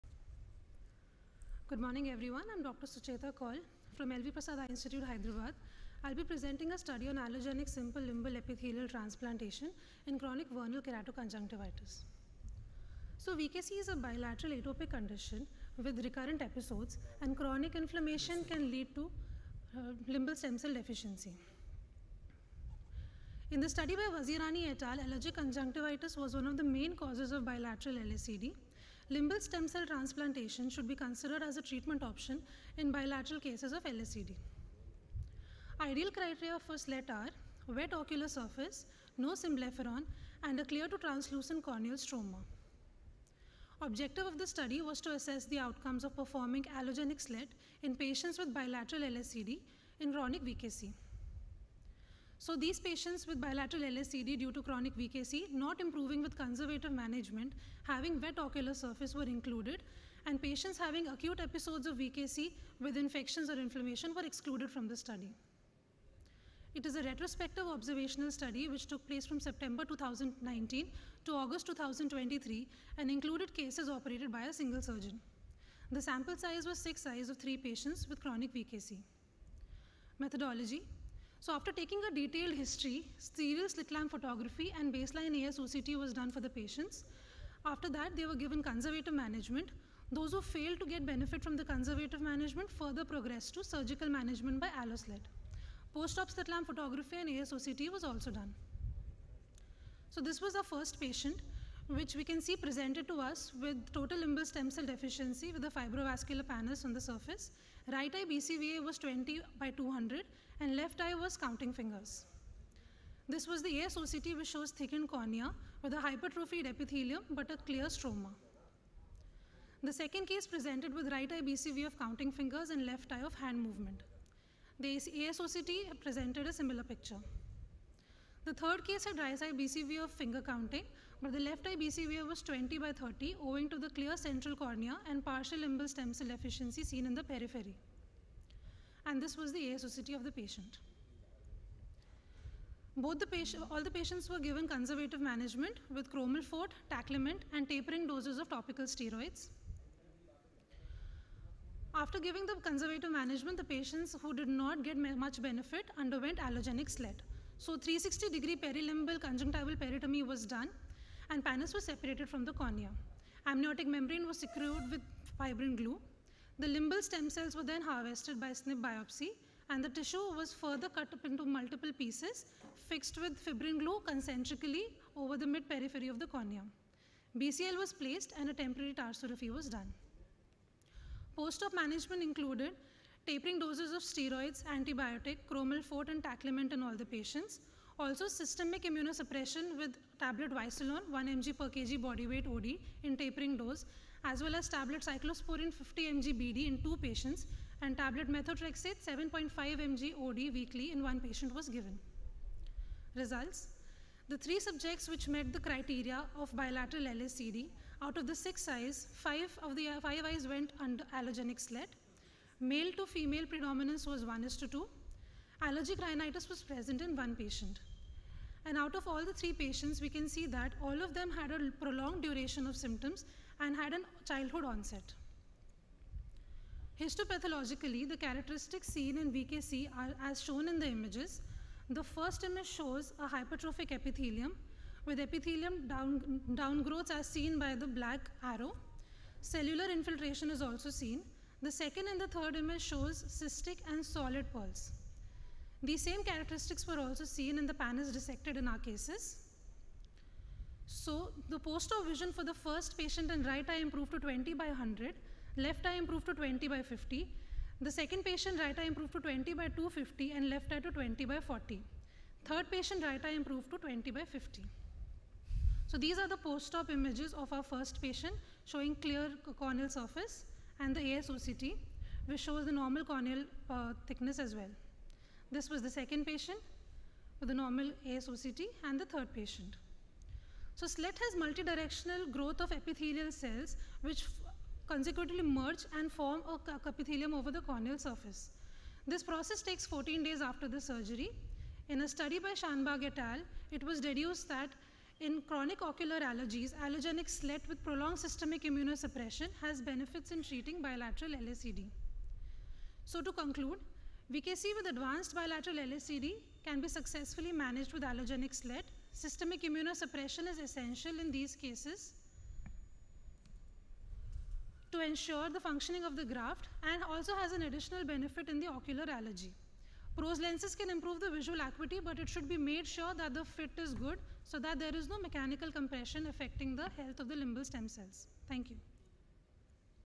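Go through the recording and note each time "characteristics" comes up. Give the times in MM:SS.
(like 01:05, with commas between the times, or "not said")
03:48, 04:06.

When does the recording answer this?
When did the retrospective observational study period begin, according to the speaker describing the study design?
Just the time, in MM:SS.
01:09.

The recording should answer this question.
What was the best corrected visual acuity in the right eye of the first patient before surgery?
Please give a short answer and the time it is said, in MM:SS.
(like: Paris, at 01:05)
20/200, at 01:48.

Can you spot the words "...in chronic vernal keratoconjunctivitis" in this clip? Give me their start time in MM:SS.
00:10.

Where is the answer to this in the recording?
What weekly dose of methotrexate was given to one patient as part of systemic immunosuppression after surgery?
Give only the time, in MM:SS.
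03:19.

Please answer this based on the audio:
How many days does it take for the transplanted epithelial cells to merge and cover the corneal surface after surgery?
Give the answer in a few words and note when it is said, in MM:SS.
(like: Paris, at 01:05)
14 days, at 04:49.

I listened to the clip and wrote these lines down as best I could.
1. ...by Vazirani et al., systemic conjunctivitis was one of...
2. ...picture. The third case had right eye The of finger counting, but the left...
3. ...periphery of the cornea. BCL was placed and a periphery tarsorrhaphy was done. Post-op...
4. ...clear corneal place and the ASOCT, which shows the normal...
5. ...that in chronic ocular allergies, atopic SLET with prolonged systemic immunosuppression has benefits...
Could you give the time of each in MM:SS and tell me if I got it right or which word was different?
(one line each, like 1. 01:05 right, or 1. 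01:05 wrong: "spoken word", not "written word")
1. 00:23 wrong: "allergic", not "systemic"
2. 02:06 wrong: "BCVA", not "The"
3. 02:55 wrong: "temporary", not "periphery"
4. 04:28 wrong: "surface", not "place"
5. 04:54 wrong: "allogenic", not "atopic".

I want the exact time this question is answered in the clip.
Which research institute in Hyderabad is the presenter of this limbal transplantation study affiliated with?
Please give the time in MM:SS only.
00:04.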